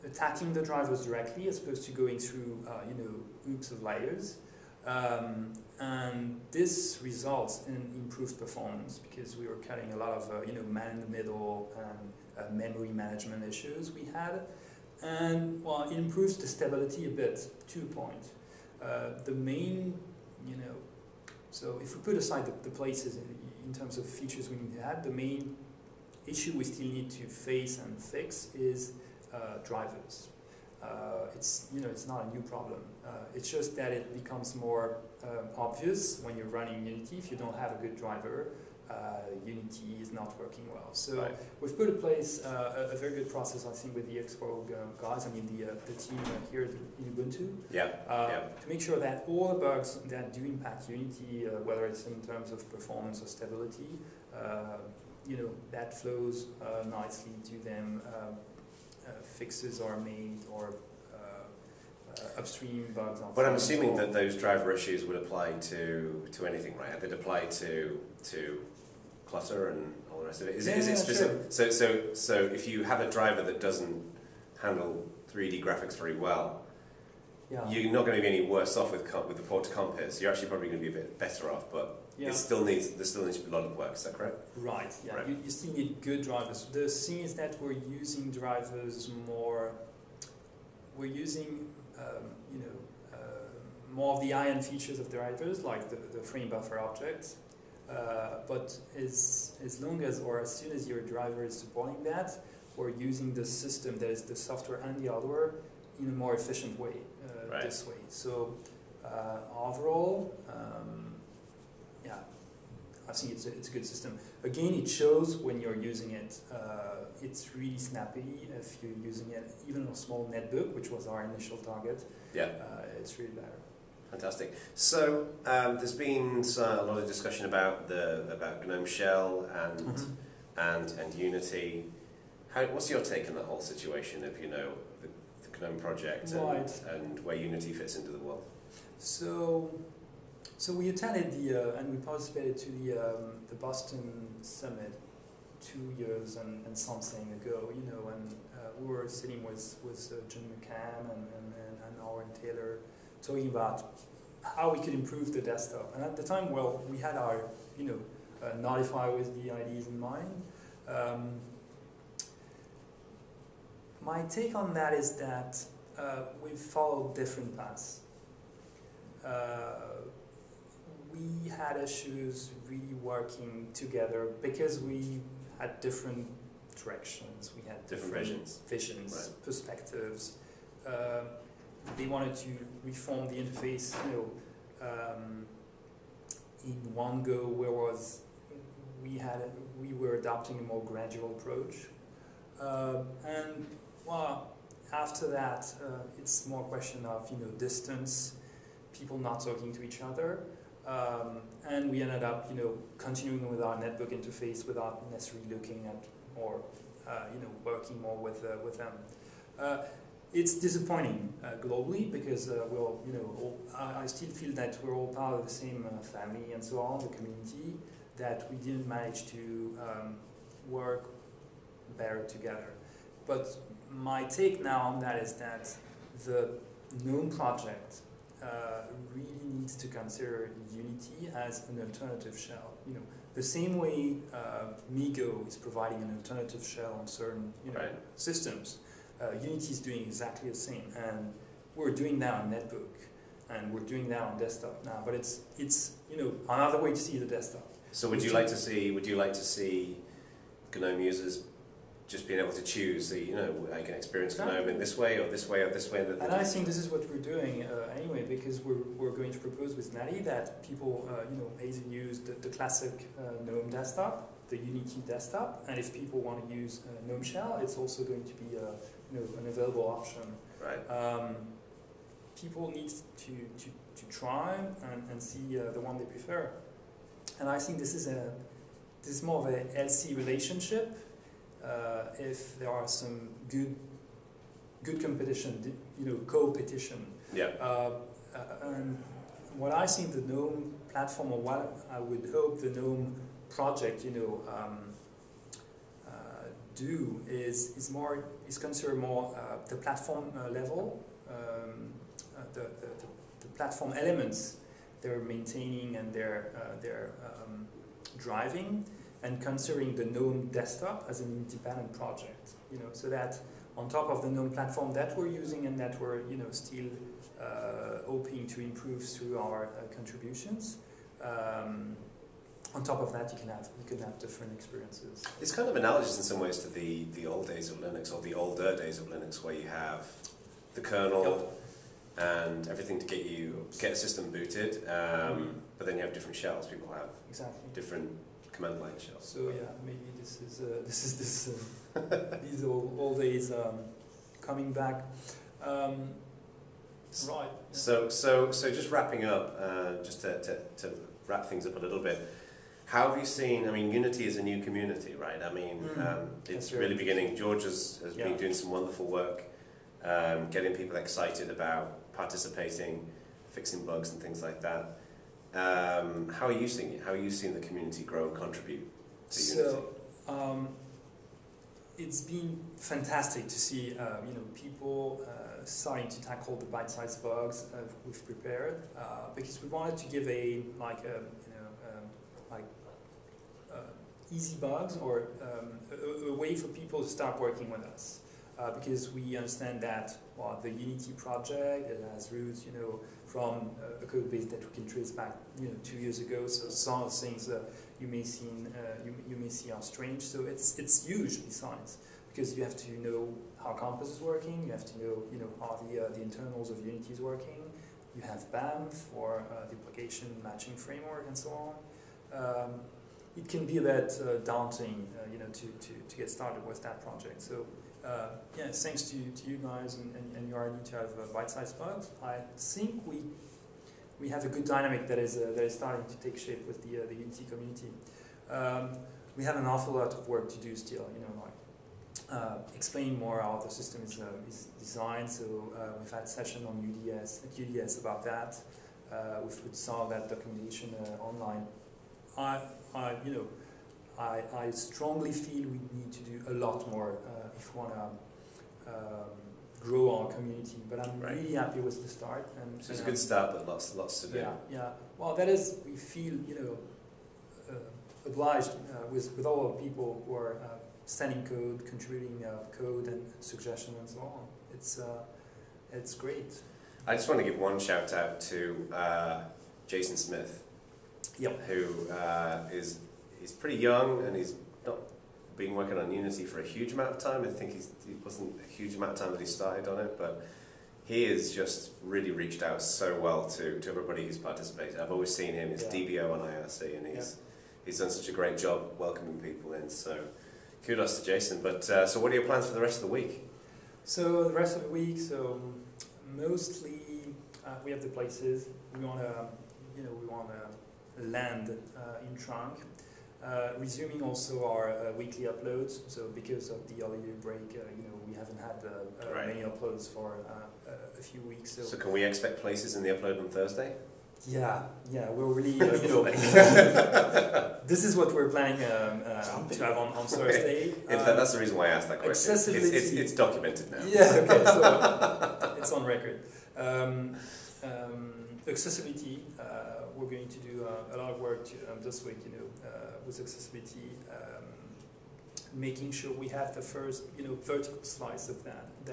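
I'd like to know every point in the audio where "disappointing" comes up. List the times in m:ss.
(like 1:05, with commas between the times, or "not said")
3:30.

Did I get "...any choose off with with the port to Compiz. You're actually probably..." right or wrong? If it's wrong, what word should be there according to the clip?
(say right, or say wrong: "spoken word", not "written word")
wrong: "worse", not "choose".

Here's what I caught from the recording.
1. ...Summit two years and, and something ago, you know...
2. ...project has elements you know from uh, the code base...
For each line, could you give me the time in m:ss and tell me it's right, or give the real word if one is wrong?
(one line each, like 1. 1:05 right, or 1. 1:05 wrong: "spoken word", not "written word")
1. 2:24 right
2. 6:31 wrong: "roots", not "elements".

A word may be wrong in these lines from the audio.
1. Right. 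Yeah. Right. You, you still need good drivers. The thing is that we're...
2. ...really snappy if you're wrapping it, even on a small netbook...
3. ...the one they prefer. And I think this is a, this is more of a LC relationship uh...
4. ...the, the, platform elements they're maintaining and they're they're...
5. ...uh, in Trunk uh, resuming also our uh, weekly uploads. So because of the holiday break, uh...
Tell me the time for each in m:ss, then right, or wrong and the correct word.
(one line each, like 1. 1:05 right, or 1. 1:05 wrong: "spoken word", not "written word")
1. 1:24 right
2. 1:57 wrong: "using", not "wrapping"
3. 4:35 right
4. 5:02 right
5. 8:21 right.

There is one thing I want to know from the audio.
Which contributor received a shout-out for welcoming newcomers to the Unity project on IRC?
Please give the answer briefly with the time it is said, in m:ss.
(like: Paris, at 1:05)
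Jason Smith, at 7:49.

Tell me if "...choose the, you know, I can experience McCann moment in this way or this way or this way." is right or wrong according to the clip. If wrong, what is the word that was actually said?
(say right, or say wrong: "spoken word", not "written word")
wrong: "Canome", not "McCann".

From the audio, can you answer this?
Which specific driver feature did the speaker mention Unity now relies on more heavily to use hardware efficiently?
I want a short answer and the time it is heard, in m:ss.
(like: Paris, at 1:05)
frame buffer object, at 1:36.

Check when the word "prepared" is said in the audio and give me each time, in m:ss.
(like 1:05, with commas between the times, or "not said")
6:18.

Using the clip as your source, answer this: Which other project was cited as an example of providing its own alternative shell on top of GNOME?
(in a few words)
MeeGo.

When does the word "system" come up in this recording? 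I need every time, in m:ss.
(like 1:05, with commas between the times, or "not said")
1:43, 1:53, 3:58, 5:33, 7:13.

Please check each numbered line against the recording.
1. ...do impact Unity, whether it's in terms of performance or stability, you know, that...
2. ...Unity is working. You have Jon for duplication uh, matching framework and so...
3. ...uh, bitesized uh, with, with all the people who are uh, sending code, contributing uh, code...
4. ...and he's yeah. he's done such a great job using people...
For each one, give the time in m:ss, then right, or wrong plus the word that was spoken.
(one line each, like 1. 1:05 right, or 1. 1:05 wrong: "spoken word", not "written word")
1. 0:50 right
2. 6:46 wrong: "BAM", not "Jon"
3. 7:37 wrong: "obliged", not "bitesized"
4. 8:06 wrong: "welcoming", not "using".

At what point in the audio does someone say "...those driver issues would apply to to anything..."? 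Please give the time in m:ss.
1:04.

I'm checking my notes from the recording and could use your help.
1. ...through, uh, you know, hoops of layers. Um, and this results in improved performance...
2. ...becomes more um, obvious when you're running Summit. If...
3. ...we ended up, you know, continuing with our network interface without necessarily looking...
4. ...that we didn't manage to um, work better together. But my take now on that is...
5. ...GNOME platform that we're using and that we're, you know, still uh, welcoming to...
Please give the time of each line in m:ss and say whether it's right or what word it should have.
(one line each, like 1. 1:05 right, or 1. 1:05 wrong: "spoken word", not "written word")
1. 0:02 right
2. 0:34 wrong: "Unity", not "Summit"
3. 3:21 right
4. 3:38 right
5. 5:14 wrong: "hoping", not "welcoming".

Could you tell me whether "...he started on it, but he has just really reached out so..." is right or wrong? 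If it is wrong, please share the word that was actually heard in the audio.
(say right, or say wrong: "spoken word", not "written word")
right.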